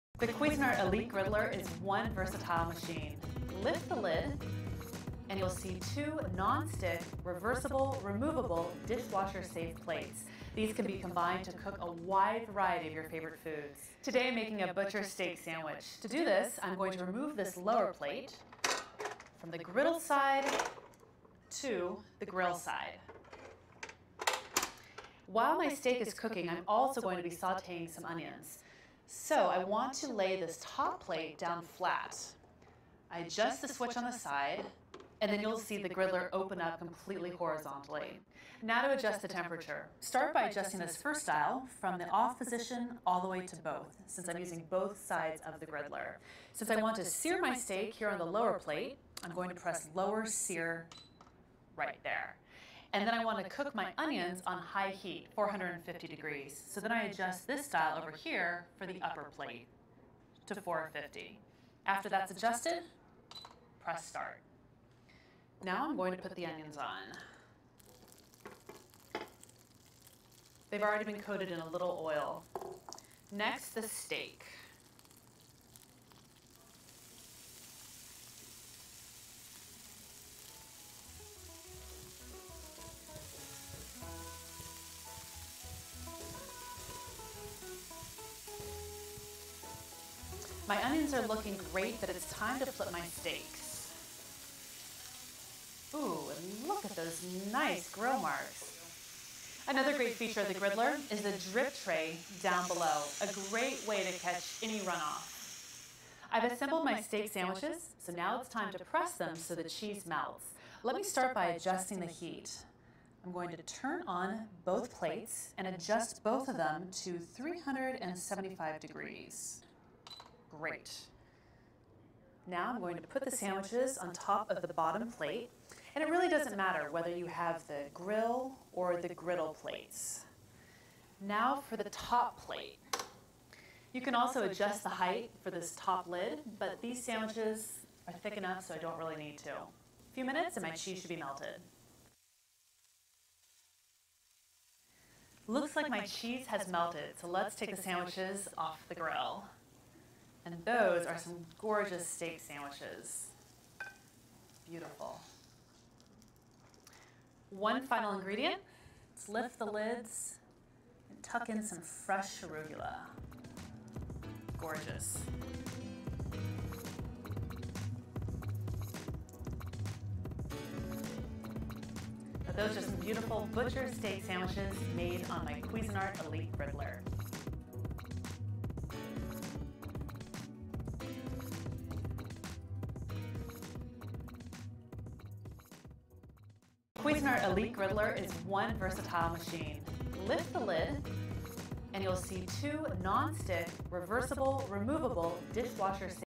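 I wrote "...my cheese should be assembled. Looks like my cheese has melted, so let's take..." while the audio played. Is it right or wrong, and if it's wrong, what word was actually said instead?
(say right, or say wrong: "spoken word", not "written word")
wrong: "melted", not "assembled".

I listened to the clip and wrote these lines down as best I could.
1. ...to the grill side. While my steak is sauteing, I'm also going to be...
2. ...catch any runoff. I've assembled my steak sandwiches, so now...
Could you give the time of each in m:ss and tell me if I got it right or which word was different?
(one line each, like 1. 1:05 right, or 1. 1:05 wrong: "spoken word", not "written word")
1. 0:21 wrong: "cooking", not "sauteing"
2. 1:44 right.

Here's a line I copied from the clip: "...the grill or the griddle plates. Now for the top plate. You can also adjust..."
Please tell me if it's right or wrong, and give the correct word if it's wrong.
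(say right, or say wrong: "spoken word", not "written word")
right.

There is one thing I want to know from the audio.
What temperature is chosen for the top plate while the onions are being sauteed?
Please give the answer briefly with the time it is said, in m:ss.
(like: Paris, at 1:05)
450 degrees, at 0:55.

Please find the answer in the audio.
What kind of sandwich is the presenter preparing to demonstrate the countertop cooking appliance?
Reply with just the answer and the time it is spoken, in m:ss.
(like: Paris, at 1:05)
Butcher steak sandwich, at 0:14.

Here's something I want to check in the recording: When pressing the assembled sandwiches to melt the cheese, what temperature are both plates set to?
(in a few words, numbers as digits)
375 degrees.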